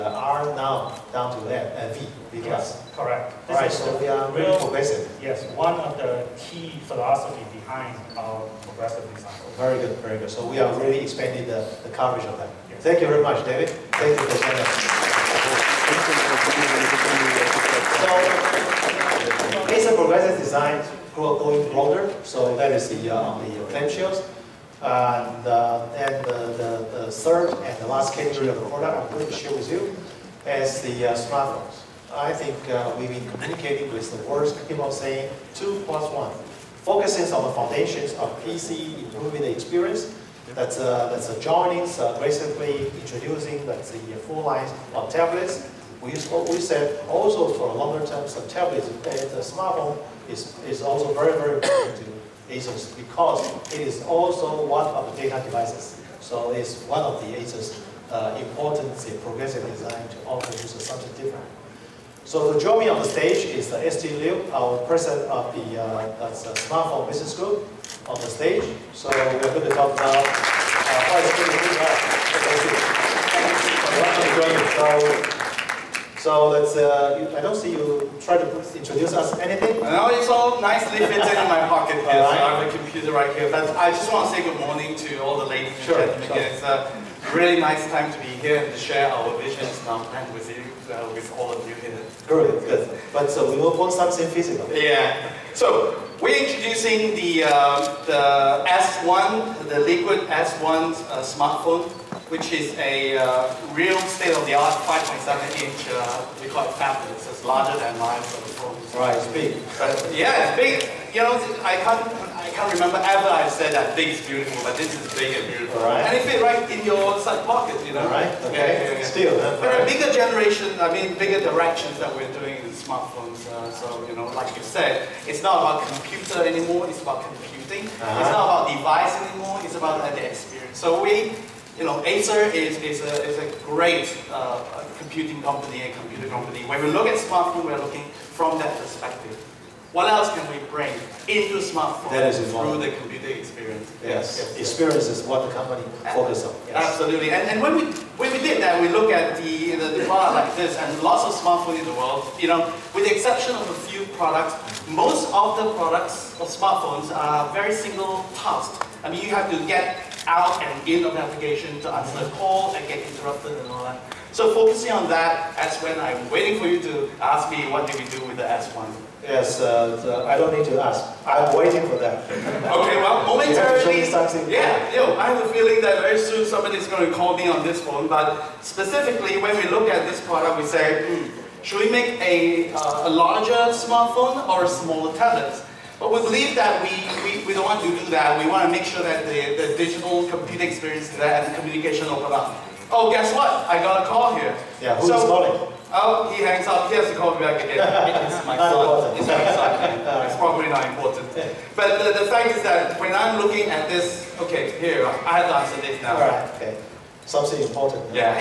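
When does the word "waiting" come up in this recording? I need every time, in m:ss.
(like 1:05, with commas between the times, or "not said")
2:46, 2:51.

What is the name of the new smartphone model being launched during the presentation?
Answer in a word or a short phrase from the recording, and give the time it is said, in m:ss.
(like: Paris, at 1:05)
Liquid S1, at 1:39.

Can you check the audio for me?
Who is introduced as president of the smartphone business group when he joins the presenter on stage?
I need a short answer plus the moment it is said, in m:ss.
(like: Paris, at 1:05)
ST Liu, at 1:03.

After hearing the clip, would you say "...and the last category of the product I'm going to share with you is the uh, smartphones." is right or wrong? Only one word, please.
right.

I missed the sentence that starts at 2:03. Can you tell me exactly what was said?
Uh, so, you know, like you said, it's not about computer anymore, it's about computing.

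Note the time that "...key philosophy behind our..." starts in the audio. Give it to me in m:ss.
0:06.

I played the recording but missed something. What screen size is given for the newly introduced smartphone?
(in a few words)
5.7-inch.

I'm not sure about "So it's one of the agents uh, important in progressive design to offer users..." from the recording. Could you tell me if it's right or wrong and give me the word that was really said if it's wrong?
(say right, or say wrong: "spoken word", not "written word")
right.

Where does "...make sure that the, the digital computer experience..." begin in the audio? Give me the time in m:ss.
3:08.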